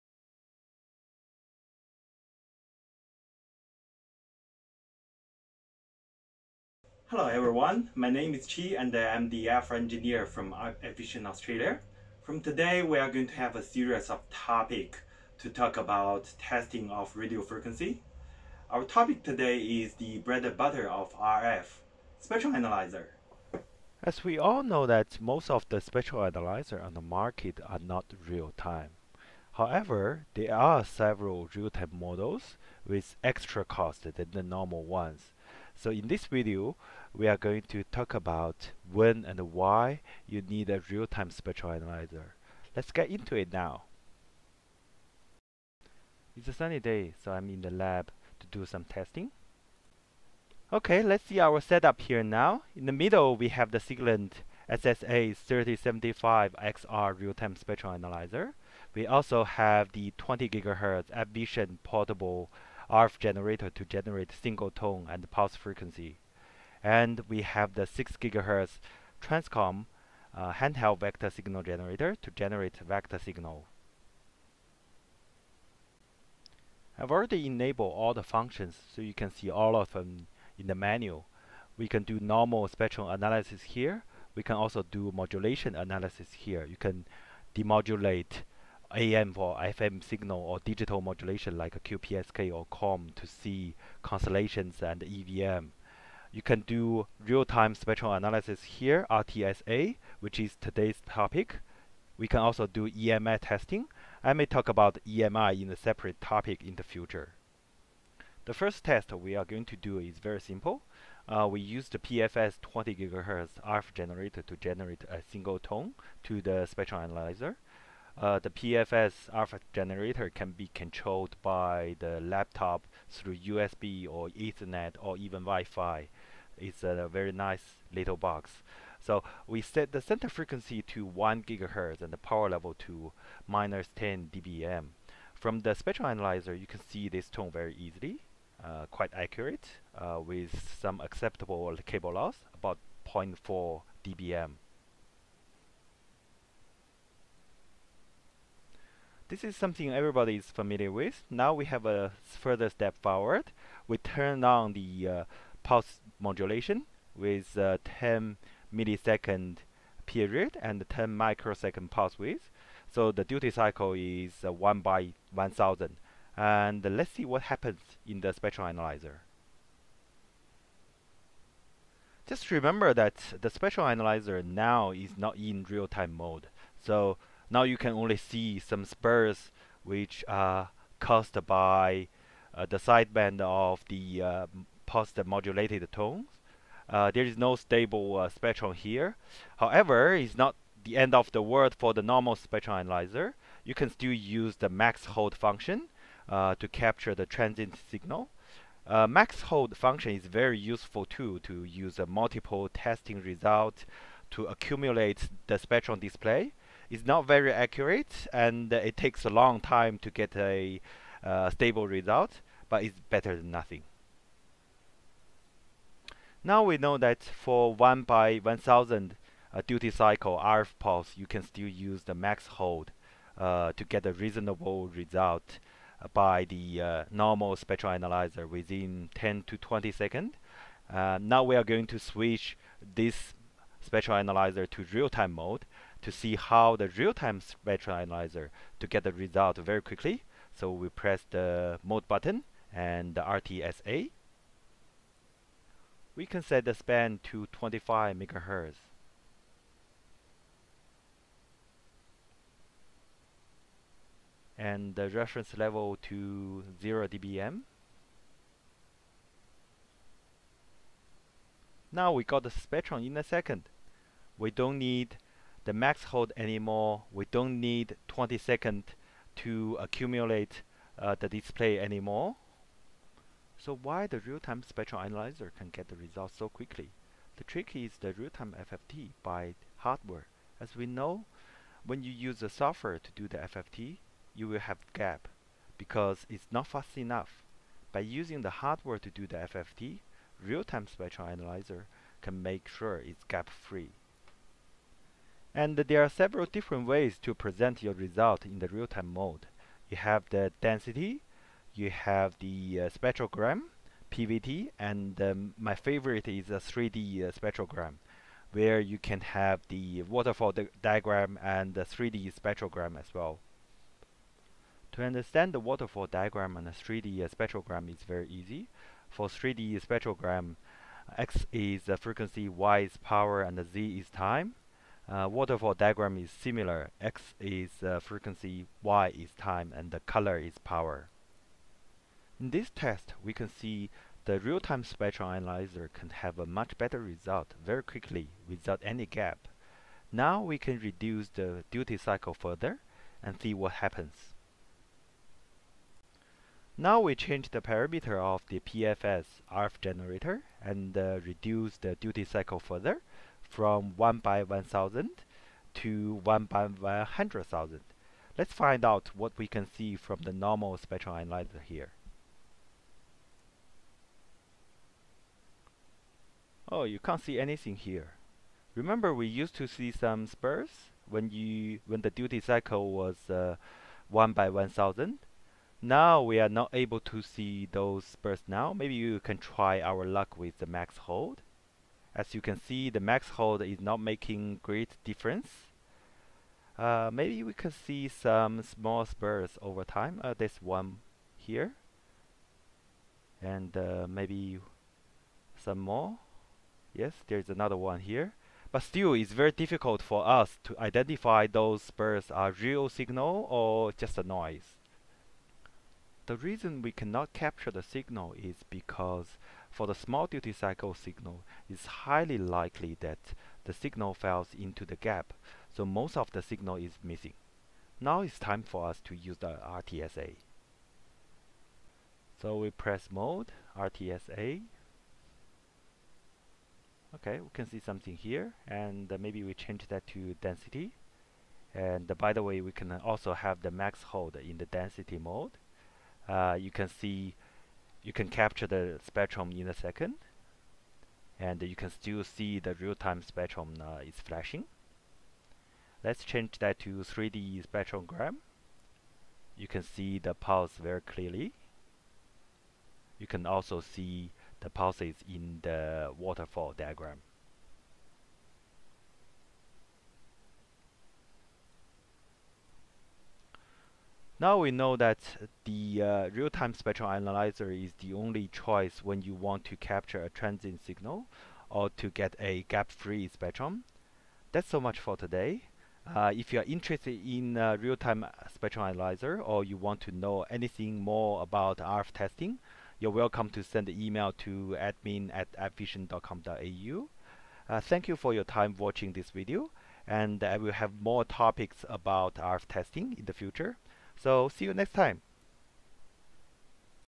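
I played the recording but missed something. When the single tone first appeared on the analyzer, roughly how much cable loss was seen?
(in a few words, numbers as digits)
0.4 dBm.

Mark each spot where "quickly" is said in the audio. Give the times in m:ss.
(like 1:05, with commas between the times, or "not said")
3:59, 4:36, 5:37.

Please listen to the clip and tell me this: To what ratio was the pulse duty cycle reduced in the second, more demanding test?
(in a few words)
1 by 100,000.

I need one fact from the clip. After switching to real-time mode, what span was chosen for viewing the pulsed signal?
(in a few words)
25 MHz.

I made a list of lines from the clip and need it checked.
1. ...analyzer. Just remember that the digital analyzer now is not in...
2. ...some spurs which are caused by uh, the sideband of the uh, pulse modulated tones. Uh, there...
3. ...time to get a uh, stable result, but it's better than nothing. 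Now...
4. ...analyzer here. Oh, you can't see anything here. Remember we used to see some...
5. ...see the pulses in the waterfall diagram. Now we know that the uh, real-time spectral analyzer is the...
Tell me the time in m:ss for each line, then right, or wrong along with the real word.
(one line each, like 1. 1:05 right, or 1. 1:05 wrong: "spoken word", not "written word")
1. 2:48 wrong: "spectral", not "digital"
2. 2:58 right
3. 3:29 right
4. 6:01 right
5. 7:33 right.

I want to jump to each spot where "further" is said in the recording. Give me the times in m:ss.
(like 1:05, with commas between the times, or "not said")
2:32, 5:42, 5:52.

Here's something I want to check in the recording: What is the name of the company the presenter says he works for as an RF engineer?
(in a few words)
AppVision Australia.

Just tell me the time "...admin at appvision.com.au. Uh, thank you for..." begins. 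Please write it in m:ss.
8:04.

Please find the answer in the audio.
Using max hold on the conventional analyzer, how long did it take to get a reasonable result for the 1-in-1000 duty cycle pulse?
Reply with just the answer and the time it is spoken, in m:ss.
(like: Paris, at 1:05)
10 to 20 seconds, at 3:49.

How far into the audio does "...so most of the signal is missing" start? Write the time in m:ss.
6:55.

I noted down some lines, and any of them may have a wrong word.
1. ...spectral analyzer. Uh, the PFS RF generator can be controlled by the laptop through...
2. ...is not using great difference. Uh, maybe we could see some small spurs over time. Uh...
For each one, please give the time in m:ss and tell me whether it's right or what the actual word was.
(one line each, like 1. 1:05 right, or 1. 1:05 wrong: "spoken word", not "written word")
1. 1:56 right
2. 6:23 wrong: "making", not "using".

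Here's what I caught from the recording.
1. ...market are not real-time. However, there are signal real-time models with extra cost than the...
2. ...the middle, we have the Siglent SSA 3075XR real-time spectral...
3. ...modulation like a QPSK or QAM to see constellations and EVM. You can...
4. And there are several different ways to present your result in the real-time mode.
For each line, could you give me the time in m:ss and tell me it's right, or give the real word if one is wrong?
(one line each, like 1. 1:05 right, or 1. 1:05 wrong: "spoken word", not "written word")
1. 0:27 wrong: "several", not "signal"
2. 0:52 right
3. 1:31 right
4. 4:55 right.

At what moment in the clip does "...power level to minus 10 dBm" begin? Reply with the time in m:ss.
2:12.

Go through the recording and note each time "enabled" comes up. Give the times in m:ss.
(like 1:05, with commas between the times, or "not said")
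1:17.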